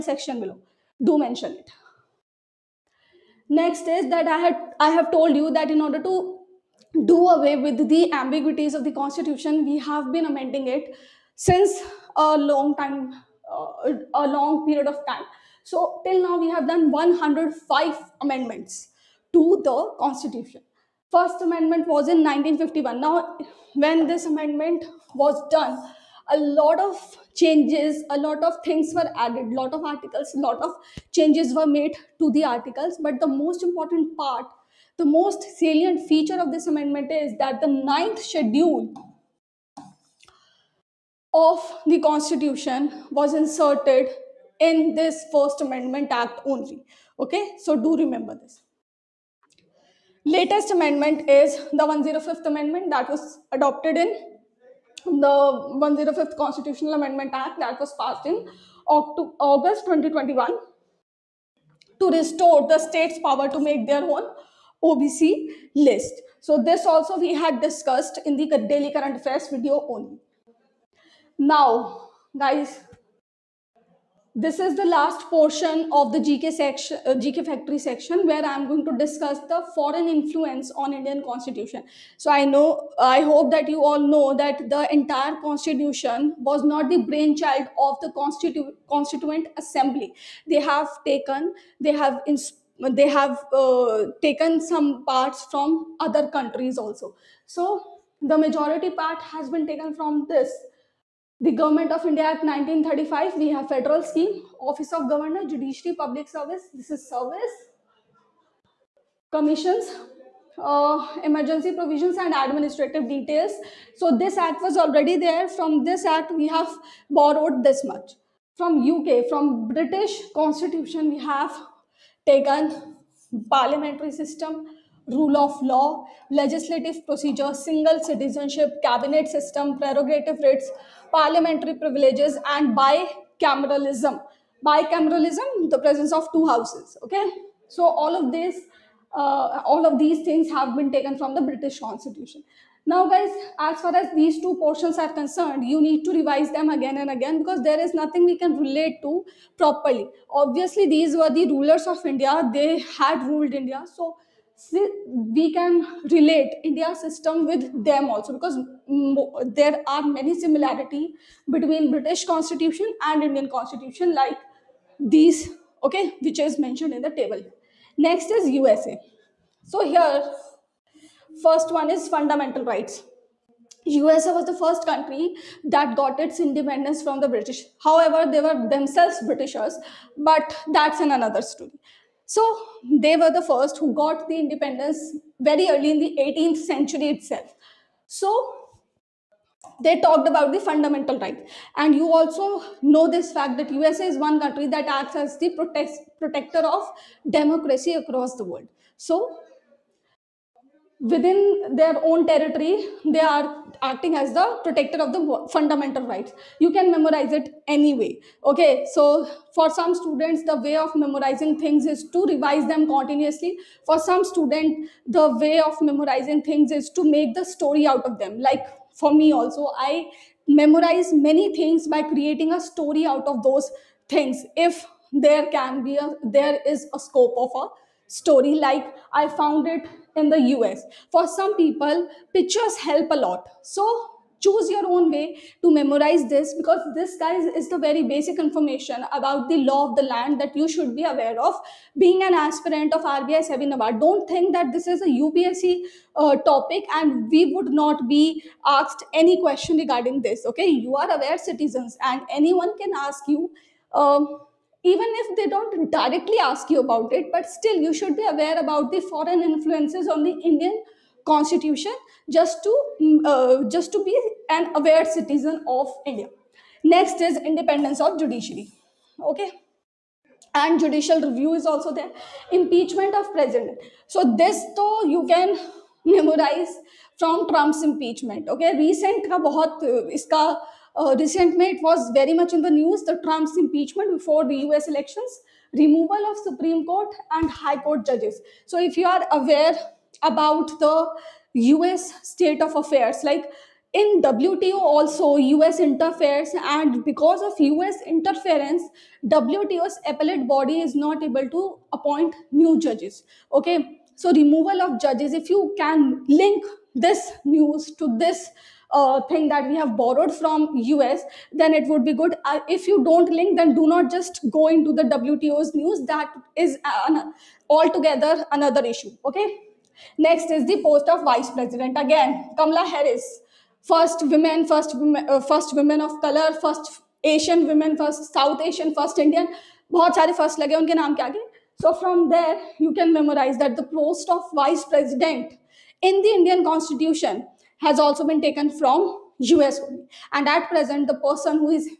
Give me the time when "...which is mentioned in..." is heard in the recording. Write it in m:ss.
2:46.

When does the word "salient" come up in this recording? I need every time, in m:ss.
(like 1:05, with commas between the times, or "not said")
0:35.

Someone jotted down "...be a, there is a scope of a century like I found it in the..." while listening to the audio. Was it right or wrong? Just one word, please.
wrong.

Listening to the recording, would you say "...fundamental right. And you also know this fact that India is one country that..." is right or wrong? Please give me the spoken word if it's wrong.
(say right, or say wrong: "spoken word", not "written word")
wrong: "USA", not "India".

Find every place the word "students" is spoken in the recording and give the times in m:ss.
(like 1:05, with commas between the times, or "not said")
3:29, 3:34.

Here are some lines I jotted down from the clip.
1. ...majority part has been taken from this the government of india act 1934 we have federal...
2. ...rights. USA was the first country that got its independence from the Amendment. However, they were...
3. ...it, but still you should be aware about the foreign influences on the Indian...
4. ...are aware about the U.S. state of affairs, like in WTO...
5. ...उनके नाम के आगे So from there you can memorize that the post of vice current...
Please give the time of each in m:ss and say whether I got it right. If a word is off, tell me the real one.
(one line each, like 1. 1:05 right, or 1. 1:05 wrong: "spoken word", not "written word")
1. 1:38 wrong: "1935", not "1934"
2. 2:52 wrong: "British", not "Amendment"
3. 4:17 right
4. 4:49 right
5. 5:30 wrong: "president", not "current".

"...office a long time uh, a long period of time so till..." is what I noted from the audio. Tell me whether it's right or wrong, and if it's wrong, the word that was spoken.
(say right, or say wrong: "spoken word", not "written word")
wrong: "since", not "office".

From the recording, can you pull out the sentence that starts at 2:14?
Bicameralism, the presence of two houses.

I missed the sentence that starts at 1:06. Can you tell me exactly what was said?
So this also we had discussed in the daily current affairs video only.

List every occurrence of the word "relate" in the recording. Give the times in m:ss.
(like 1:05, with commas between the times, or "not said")
2:28, 2:36.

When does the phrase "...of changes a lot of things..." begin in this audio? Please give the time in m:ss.
0:26.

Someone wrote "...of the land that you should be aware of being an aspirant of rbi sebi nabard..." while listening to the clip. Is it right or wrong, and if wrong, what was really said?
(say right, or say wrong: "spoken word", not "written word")
right.